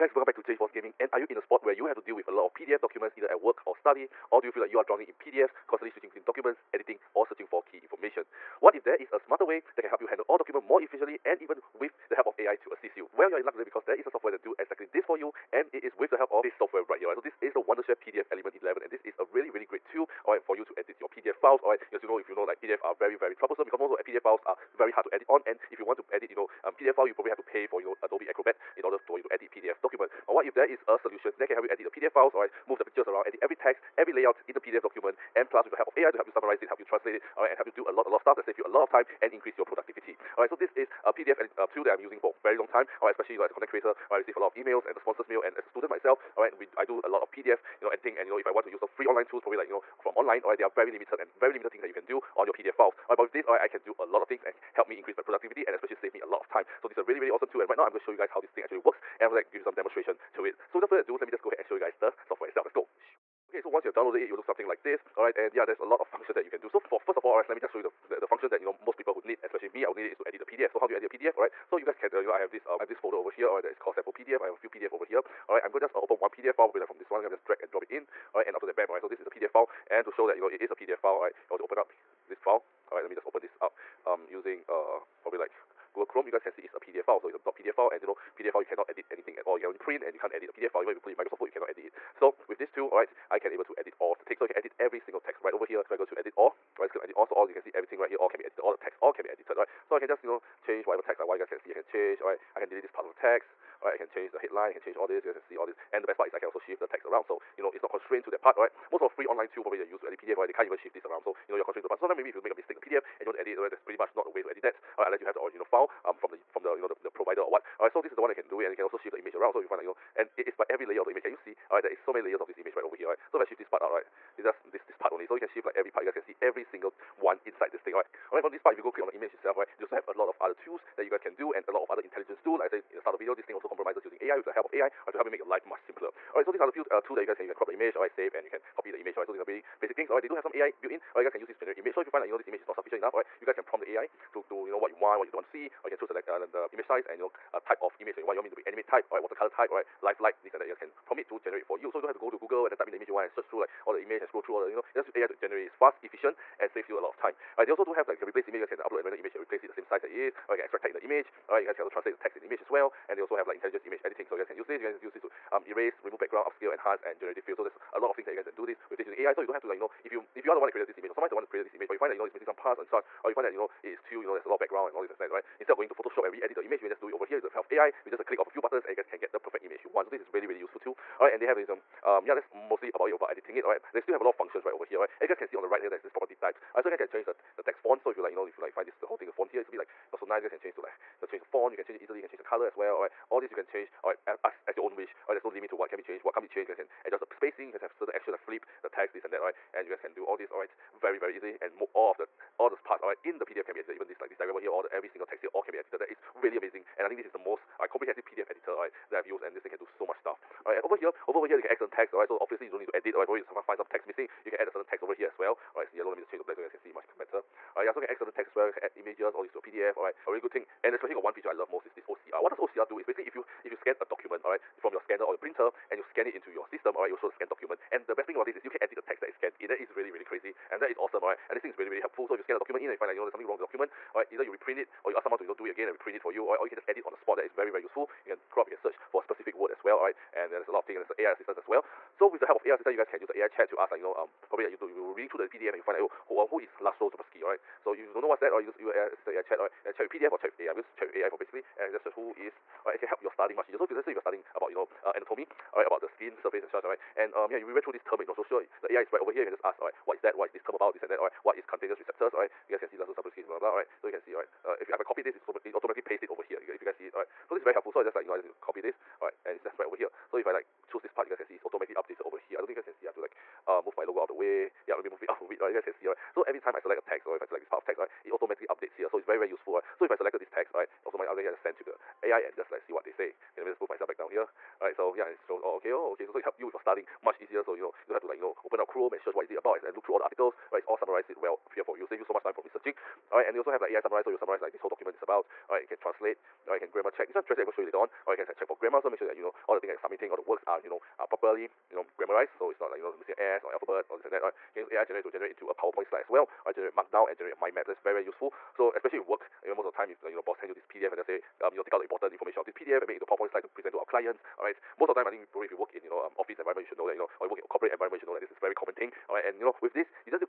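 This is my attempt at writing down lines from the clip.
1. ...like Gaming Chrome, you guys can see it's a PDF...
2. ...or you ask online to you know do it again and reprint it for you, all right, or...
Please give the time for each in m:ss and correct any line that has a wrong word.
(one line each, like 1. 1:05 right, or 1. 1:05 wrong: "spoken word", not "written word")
1. 1:25 wrong: "Google", not "Gaming"
2. 3:55 wrong: "someone", not "online".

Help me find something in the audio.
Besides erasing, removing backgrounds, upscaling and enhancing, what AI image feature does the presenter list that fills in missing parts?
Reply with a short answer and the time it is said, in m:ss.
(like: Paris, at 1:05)
generative fill, at 2:47.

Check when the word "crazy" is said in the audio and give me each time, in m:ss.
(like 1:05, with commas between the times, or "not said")
3:50.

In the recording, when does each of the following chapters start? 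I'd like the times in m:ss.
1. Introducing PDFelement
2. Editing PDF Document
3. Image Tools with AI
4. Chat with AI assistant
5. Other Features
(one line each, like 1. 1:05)
1. 0:16
2. 1:36
3. 2:09
4. 4:11
5. 5:08.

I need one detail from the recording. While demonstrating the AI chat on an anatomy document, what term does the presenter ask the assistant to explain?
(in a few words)
cutaneous receptors.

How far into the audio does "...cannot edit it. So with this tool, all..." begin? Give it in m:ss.
1:31.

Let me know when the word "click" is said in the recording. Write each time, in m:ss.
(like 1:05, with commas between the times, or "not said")
1:36, 2:08, 2:58.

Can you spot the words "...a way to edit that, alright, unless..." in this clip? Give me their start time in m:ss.
1:54.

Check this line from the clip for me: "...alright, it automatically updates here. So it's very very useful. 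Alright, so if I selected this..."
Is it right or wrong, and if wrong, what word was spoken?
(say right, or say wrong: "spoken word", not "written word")
right.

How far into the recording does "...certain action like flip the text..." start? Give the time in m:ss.
3:17.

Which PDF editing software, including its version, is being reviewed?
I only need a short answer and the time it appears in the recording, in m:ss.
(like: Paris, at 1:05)
PDF Element 11, at 0:18.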